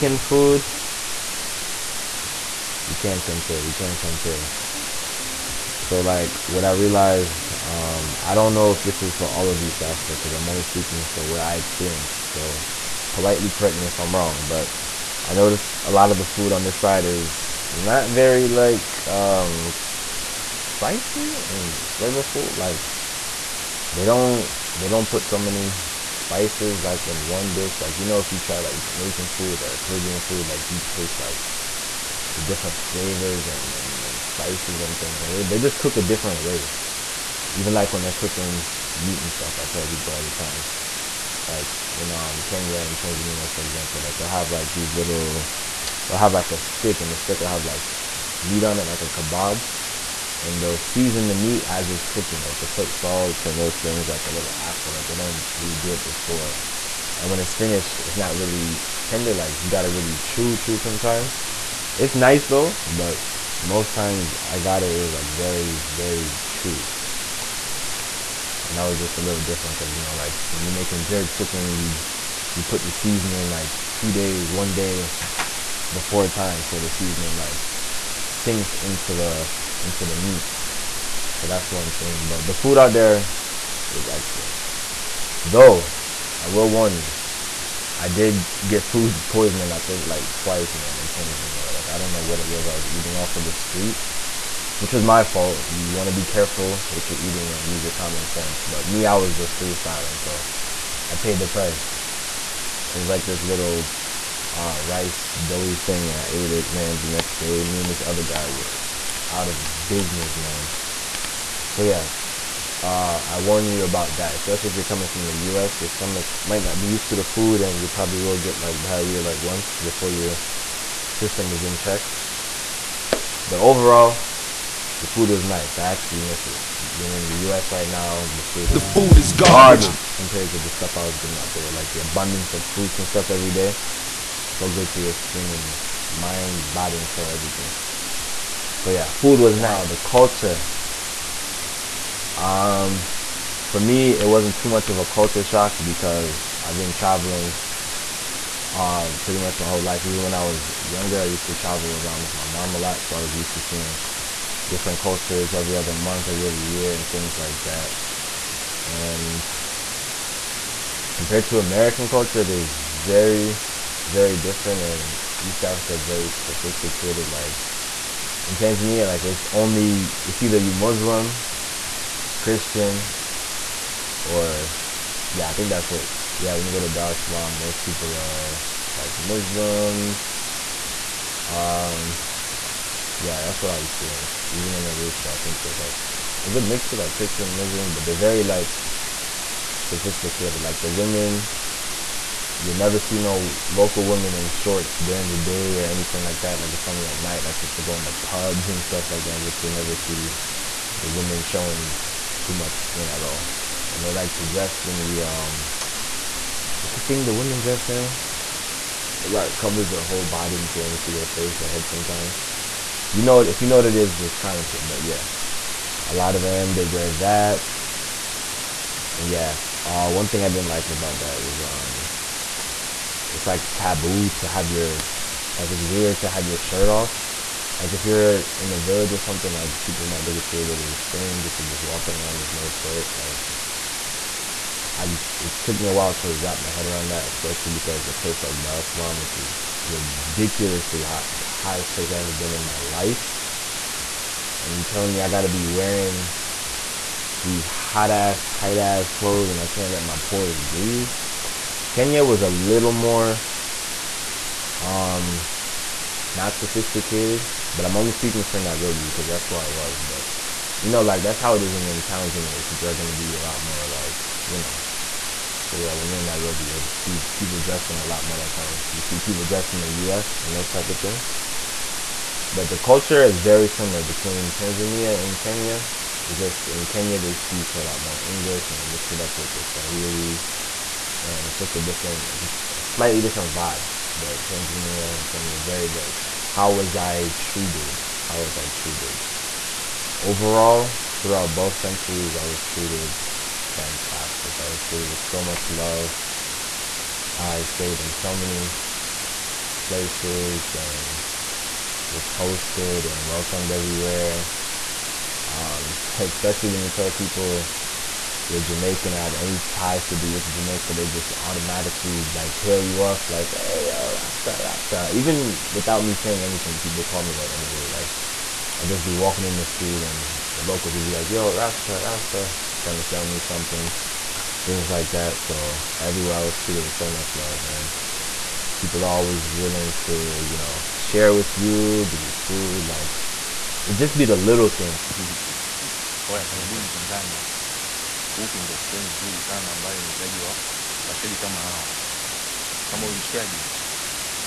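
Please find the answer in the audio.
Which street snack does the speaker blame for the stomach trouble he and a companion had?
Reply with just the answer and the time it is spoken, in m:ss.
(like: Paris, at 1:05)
rice doughy thing, at 1:44.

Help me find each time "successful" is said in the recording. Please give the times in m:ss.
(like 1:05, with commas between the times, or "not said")
not said.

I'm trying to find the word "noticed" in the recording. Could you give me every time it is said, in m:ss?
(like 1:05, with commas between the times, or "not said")
0:15.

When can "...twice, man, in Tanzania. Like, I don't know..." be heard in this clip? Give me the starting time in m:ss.
1:30.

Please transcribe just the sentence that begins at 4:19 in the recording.
But you know, like that's how it is when you're in towns anyway.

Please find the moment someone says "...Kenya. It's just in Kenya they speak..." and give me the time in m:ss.
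4:35.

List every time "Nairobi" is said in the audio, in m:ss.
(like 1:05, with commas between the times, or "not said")
4:18, 4:26.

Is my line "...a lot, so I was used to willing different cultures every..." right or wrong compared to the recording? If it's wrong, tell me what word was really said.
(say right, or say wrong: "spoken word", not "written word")
wrong: "seeing", not "willing".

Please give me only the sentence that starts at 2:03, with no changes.
But overall, the food was nice.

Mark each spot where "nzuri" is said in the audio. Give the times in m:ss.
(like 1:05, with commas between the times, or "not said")
5:39.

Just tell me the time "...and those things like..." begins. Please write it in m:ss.
0:53.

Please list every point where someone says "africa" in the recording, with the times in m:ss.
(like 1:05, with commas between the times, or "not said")
0:09, 2:45.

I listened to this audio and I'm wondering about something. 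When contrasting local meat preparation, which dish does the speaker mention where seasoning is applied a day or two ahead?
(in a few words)
jerk chicken.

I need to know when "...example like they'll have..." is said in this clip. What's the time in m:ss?
0:43.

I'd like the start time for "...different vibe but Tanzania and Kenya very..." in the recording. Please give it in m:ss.
4:43.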